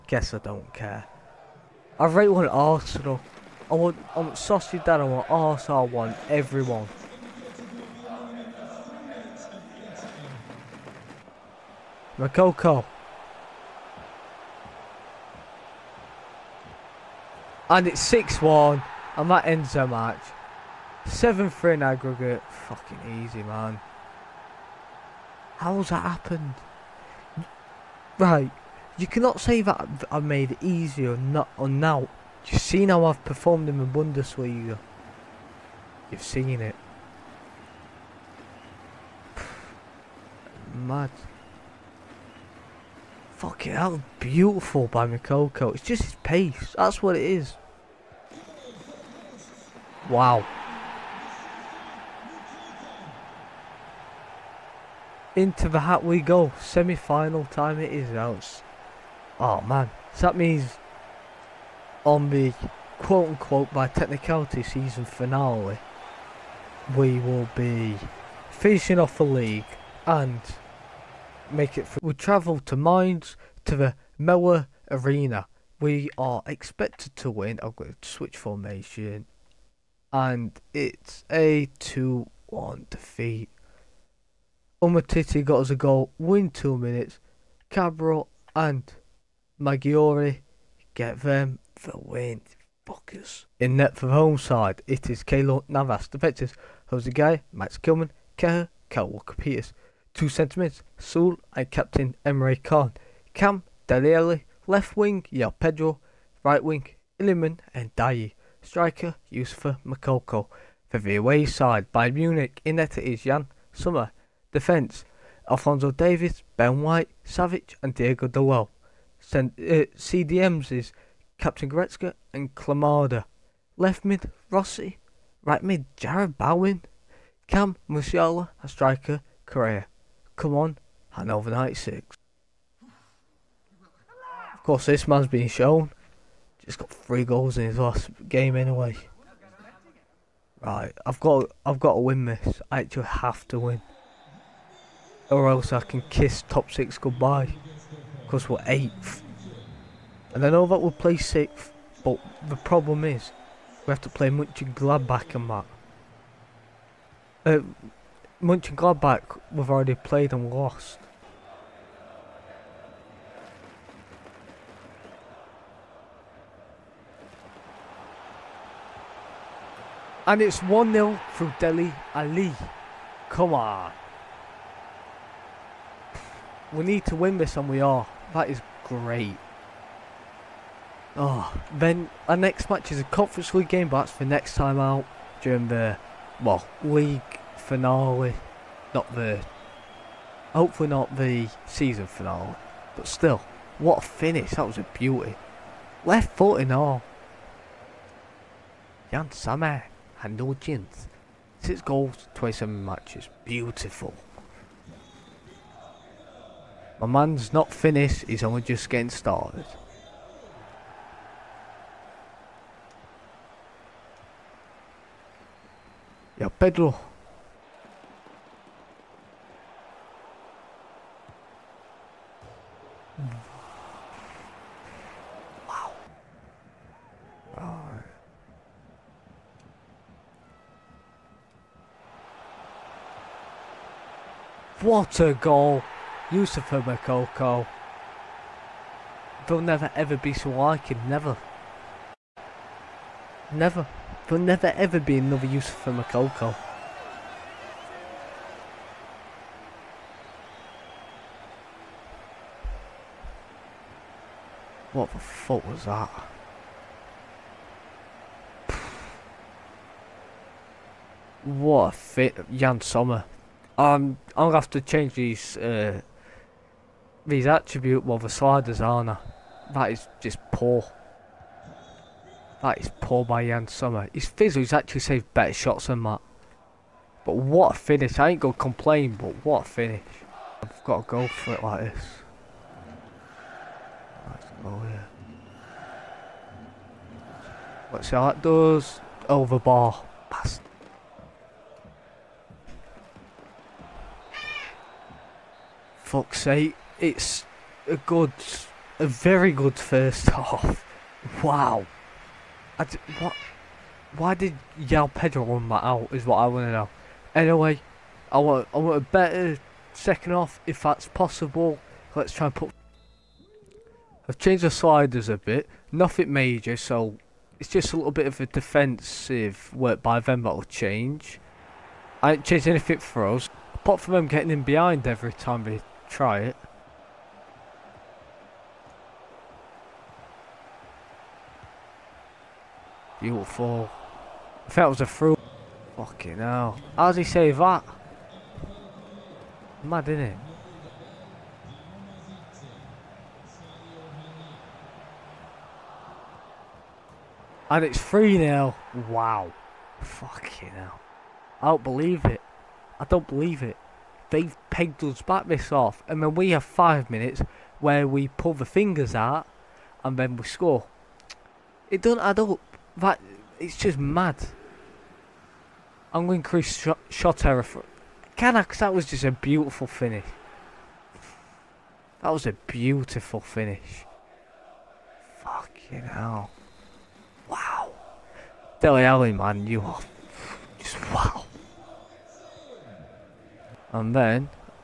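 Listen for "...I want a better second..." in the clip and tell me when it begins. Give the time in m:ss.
5:08.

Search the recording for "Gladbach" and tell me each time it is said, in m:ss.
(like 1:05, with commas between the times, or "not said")
2:34, 2:38.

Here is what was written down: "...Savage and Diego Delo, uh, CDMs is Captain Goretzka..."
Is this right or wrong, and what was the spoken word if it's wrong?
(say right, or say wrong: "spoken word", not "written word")
right.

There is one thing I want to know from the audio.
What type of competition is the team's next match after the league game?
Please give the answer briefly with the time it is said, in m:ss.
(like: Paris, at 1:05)
Conference League, at 3:03.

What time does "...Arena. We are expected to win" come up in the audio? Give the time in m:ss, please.
1:14.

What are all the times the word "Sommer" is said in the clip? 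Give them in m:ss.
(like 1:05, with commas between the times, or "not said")
1:53, 4:22, 4:33.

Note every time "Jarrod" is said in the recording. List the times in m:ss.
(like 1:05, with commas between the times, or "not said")
2:05.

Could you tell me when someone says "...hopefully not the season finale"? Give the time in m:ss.
3:10.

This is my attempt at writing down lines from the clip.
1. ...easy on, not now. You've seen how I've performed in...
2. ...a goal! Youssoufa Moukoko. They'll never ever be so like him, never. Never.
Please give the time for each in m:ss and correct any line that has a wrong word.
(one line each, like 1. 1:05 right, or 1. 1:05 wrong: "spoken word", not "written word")
1. 0:30 right
2. 3:55 right.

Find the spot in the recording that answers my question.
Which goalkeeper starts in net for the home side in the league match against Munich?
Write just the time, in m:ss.
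1:35.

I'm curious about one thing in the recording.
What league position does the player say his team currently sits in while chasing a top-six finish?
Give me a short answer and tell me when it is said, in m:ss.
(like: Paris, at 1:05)
8th, at 2:28.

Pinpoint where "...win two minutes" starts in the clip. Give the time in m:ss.
1:26.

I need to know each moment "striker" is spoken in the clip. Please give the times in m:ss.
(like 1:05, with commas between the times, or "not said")
1:48, 2:08.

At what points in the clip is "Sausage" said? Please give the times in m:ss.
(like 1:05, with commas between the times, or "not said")
0:04.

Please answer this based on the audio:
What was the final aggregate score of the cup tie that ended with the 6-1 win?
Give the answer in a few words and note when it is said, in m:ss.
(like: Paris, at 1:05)
7-3, at 0:21.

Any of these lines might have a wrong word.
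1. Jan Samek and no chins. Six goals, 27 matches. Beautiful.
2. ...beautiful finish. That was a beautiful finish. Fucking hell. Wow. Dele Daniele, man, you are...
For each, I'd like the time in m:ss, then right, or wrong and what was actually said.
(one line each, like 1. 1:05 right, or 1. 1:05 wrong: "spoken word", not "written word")
1. 3:19 right
2. 6:09 wrong: "Alli", not "Daniele".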